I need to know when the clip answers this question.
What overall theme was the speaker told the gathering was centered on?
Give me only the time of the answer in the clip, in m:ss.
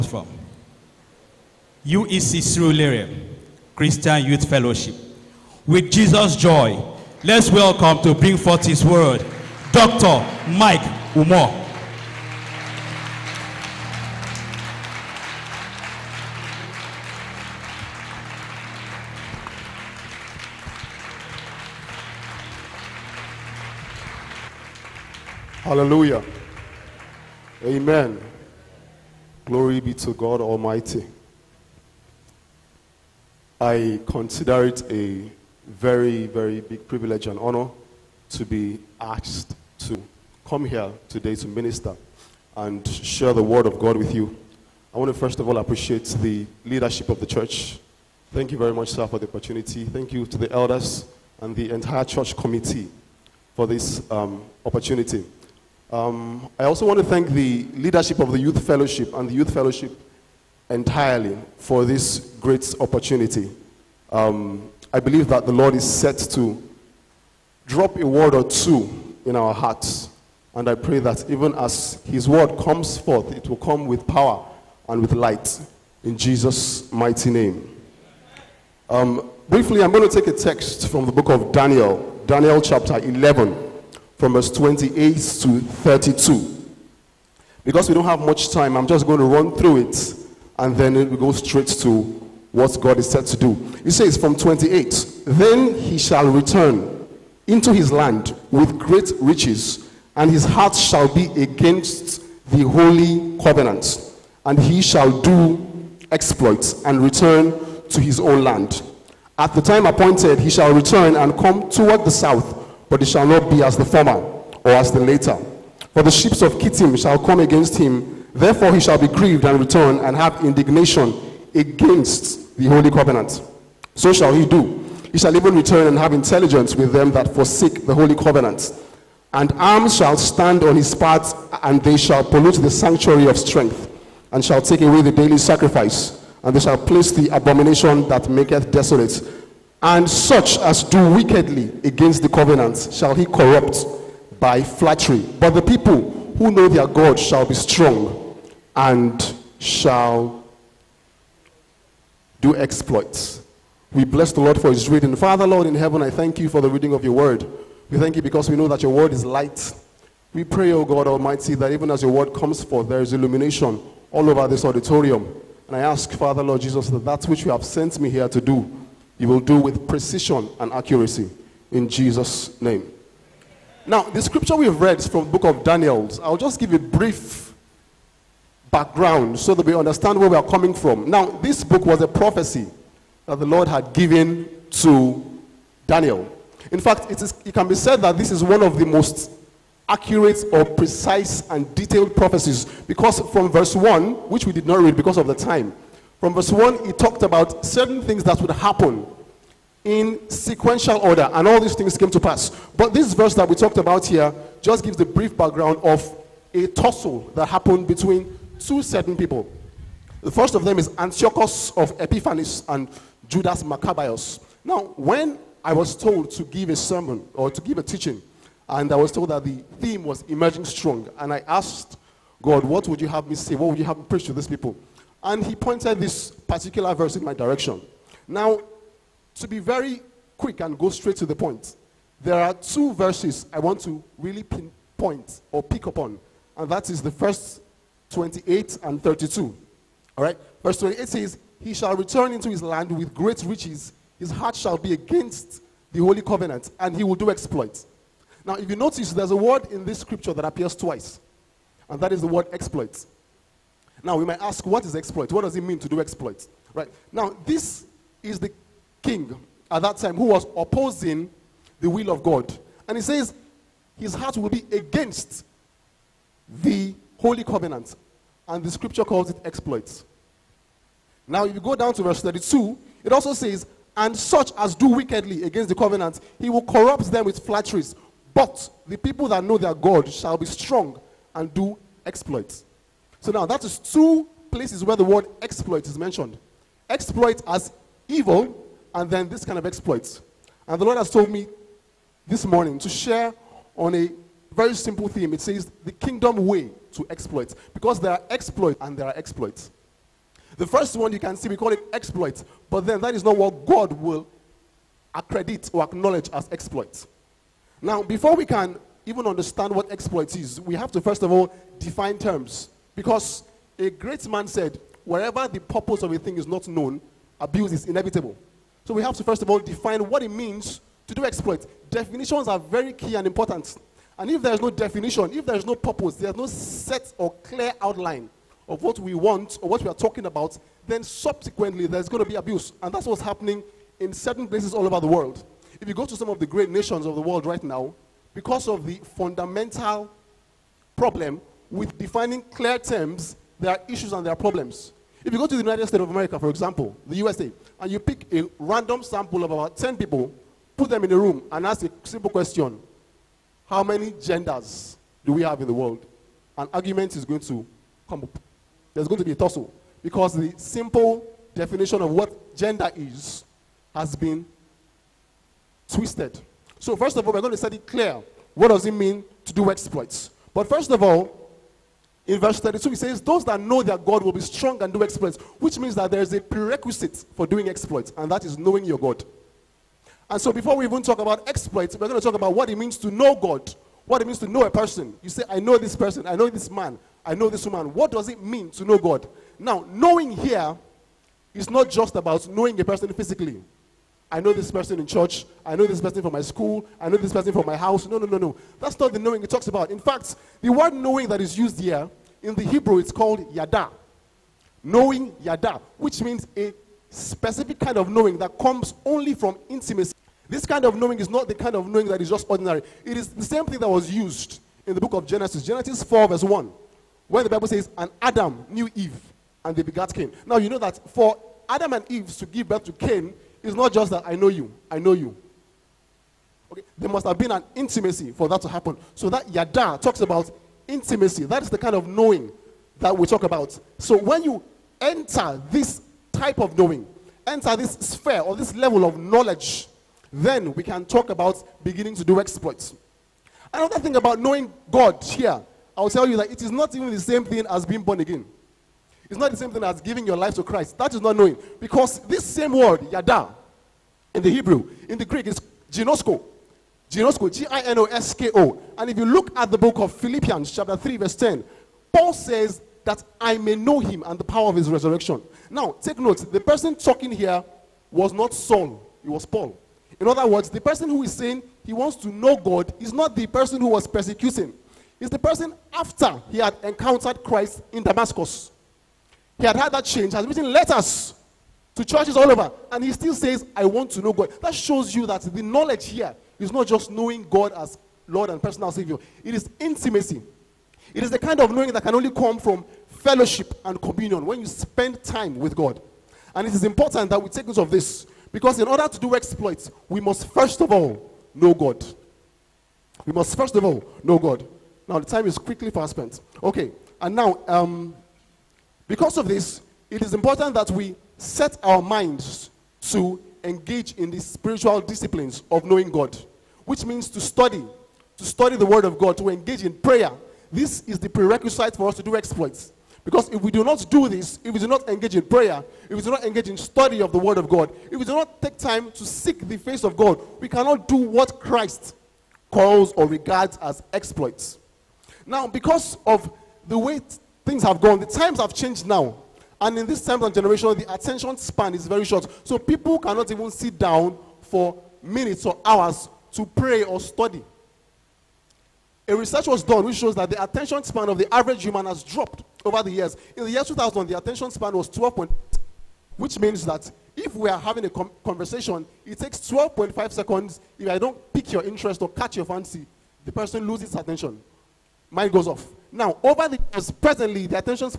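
3:40.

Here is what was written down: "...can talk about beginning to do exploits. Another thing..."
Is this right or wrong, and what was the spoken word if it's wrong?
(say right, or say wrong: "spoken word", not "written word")
right.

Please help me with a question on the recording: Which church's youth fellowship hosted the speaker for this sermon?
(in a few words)
UEC Surulere.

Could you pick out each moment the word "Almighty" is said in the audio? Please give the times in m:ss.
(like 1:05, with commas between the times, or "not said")
0:30, 2:41.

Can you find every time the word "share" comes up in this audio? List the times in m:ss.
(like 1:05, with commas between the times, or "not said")
0:42, 4:52.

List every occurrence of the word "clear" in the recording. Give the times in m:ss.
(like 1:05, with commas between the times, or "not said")
5:27, 5:42, 6:07.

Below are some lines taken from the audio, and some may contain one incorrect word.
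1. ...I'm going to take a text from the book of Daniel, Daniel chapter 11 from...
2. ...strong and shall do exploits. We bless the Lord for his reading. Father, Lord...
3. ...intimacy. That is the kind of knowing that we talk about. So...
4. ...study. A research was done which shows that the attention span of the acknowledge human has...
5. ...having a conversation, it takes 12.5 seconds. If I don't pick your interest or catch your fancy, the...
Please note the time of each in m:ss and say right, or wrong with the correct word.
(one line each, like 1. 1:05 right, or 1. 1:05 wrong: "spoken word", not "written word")
1. 1:19 right
2. 2:27 right
3. 7:10 right
4. 9:07 wrong: "average", not "acknowledge"
5. 9:17 right.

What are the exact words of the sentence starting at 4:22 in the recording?
And he says his heart will be against the holy covenant.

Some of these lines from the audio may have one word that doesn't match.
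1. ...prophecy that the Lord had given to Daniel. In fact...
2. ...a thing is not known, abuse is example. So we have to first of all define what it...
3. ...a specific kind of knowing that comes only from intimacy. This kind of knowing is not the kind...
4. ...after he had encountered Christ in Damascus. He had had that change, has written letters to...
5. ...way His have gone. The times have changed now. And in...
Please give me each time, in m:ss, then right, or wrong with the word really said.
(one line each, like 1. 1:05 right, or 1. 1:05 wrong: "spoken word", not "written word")
1. 3:02 right
2. 5:16 wrong: "inevitable", not "example"
3. 6:46 right
4. 7:55 right
5. 8:56 wrong: "Things", not "His".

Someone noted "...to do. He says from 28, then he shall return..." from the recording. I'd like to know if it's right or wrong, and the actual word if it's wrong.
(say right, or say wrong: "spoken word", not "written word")
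right.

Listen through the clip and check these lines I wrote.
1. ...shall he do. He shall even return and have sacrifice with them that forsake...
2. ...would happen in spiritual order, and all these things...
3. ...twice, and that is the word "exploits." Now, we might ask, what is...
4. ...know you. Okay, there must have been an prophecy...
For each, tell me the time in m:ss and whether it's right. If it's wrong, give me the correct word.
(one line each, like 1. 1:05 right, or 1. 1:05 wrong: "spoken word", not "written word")
1. 2:04 wrong: "intelligence", not "sacrifice"
2. 3:18 wrong: "sequential", not "spiritual"
3. 4:10 right
4. 7:04 wrong: "intimacy", not "prophecy".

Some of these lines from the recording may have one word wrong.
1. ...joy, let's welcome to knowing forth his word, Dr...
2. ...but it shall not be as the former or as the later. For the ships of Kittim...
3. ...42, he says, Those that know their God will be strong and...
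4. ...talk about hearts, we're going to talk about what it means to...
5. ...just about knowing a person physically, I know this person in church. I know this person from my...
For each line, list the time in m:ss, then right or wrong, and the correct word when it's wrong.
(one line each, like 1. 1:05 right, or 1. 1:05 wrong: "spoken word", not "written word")
1. 0:06 wrong: "bring", not "knowing"
2. 1:52 right
3. 6:12 wrong: "32", not "42"
4. 6:21 wrong: "exploits", not "hearts"
5. 6:31 right.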